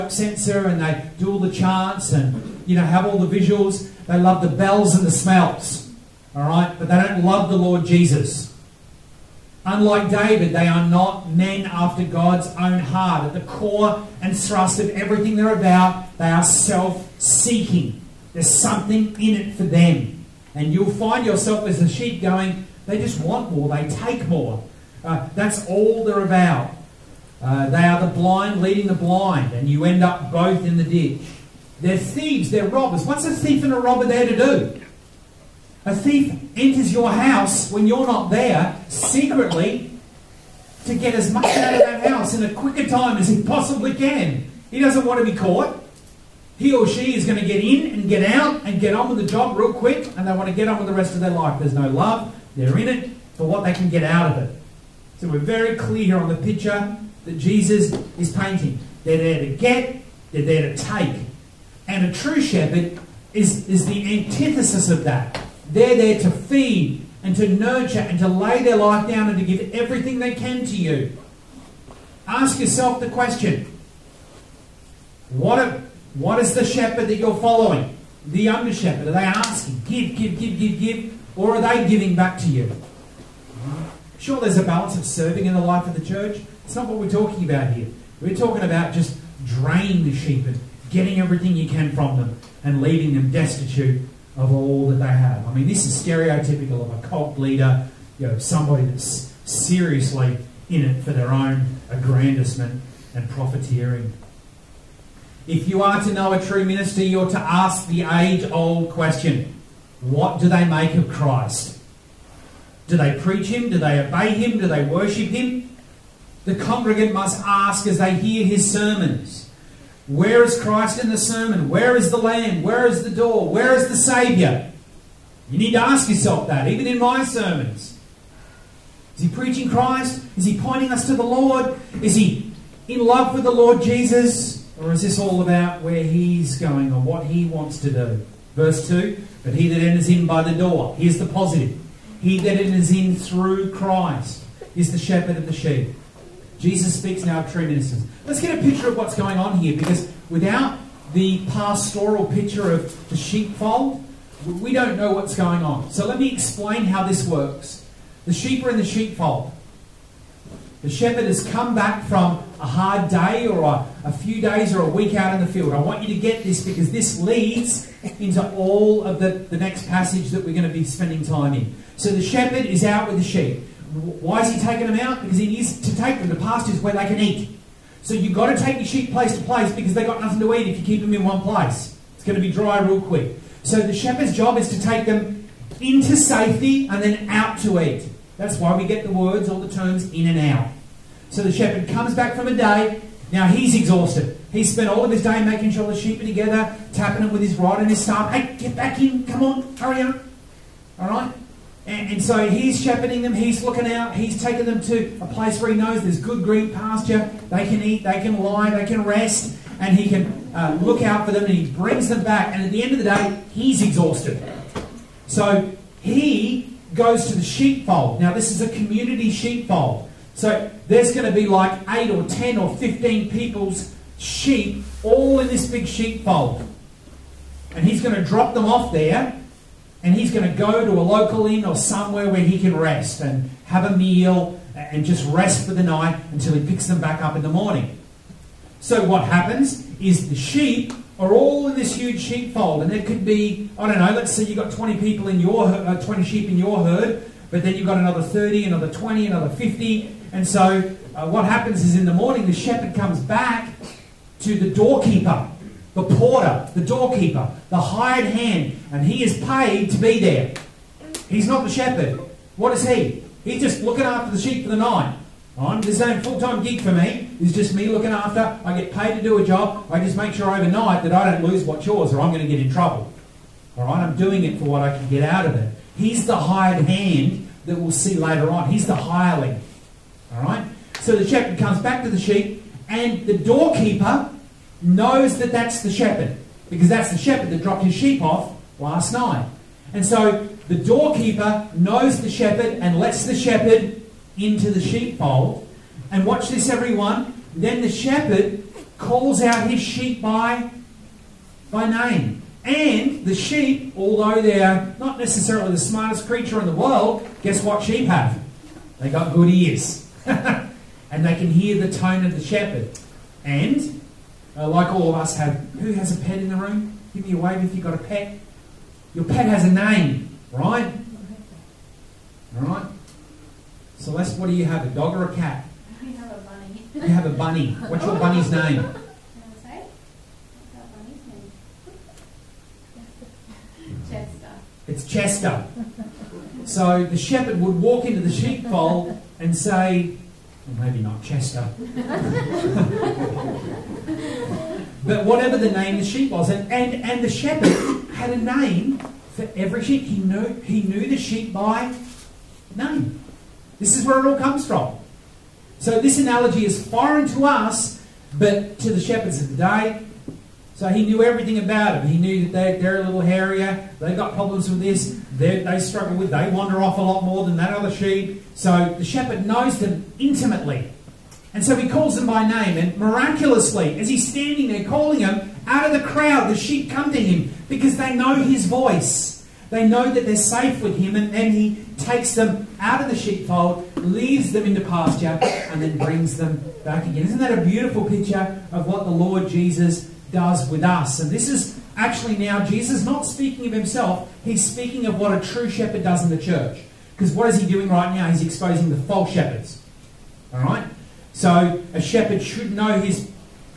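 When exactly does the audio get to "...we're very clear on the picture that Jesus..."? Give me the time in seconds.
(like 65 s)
55 s.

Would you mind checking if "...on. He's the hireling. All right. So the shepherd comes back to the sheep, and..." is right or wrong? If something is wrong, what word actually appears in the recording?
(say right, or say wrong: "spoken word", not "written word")
right.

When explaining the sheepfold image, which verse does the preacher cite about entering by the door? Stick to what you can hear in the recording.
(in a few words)
2.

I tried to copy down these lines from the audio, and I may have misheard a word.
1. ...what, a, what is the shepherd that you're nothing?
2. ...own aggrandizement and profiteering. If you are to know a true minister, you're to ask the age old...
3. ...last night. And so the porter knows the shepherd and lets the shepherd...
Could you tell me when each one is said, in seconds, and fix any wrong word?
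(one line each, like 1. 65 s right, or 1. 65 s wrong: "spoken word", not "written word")
1. 75 s wrong: "following", not "nothing"
2. 101 s right
3. 288 s wrong: "doorkeeper", not "porter".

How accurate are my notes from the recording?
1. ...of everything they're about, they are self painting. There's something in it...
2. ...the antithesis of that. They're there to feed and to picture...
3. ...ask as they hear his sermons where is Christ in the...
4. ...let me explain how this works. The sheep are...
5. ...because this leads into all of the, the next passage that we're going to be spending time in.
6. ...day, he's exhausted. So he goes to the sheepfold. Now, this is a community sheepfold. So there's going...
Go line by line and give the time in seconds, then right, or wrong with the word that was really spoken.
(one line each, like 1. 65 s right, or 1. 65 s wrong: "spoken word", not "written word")
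1. 14 s wrong: "seeking", not "painting"
2. 63 s wrong: "nurture", not "picture"
3. 117 s right
4. 156 s right
5. 166 s right
6. 213 s right.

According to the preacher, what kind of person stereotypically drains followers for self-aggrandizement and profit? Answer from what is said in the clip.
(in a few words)
A cult leader.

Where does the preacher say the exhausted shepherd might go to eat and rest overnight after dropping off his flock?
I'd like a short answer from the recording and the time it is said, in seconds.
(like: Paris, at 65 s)
A local inn, at 230 s.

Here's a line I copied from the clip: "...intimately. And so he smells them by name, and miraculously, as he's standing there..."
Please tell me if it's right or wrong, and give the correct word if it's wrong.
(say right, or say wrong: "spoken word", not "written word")
wrong: "calls", not "smells".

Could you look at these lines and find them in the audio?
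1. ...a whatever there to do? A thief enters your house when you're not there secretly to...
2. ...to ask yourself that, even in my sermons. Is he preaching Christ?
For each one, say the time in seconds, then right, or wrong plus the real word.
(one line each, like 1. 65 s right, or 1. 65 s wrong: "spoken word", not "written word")
1. 33 s wrong: "robber", not "whatever"
2. 125 s right.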